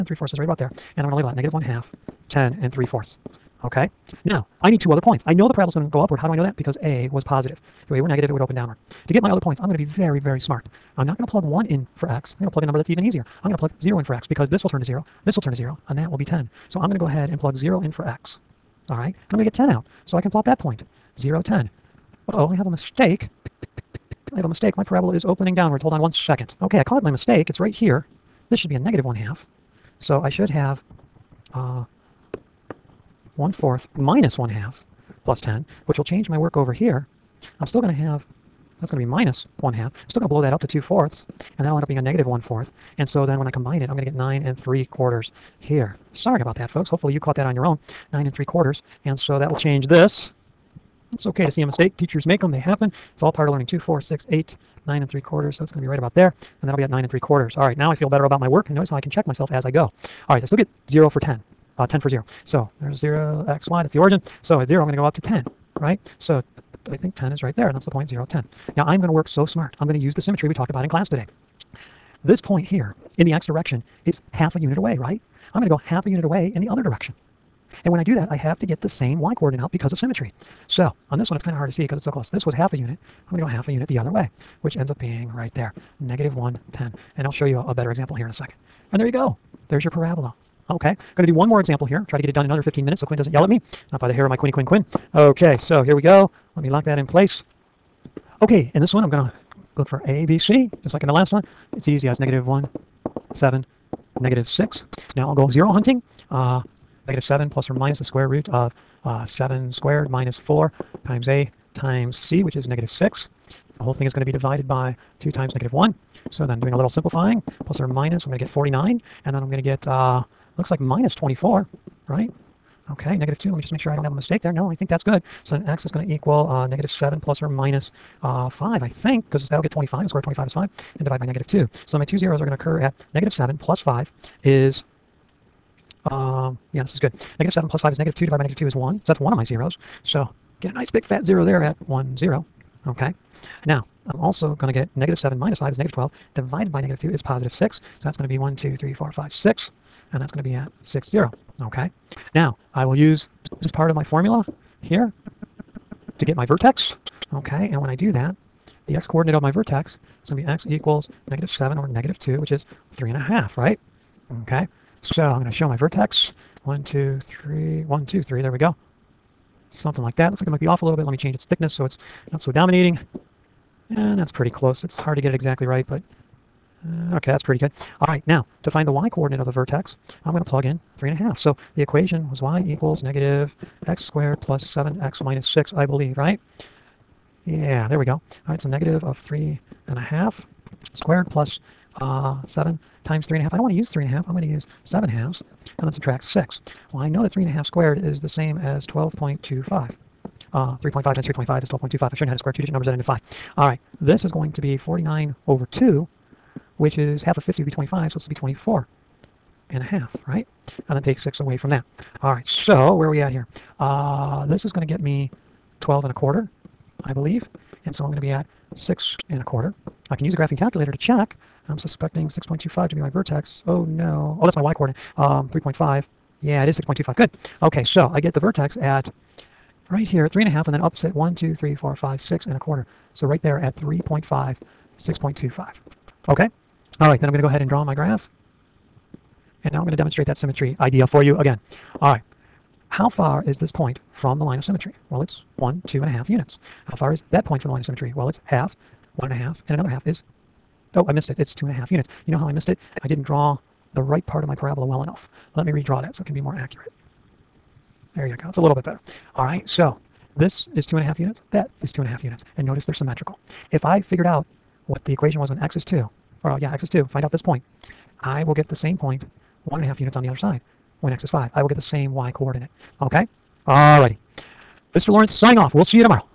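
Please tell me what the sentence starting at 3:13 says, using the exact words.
I don't want to use 3 and a half.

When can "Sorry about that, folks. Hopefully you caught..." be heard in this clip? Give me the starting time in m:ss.
0:46.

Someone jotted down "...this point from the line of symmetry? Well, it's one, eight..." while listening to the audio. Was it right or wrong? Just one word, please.
wrong.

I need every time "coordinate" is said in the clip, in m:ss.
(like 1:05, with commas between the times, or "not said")
1:19, 2:38, 2:59, 3:44, 4:32.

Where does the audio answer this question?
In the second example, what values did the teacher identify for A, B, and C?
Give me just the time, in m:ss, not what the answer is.
1:42.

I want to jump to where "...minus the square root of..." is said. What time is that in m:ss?
1:47.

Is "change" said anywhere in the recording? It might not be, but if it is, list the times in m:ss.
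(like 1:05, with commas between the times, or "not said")
0:36, 0:49, 2:51.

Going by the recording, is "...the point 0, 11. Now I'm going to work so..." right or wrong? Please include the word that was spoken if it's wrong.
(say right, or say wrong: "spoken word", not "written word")
wrong: "10", not "11".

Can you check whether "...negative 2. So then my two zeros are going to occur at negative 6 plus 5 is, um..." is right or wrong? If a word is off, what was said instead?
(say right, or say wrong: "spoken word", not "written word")
wrong: "7", not "6".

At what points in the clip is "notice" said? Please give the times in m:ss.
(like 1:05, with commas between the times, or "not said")
0:58, 4:22.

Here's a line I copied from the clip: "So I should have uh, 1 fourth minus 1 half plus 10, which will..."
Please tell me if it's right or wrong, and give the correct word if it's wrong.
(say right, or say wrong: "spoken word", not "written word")
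right.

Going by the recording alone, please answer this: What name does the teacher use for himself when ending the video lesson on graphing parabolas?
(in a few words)
Mr. Lawrence.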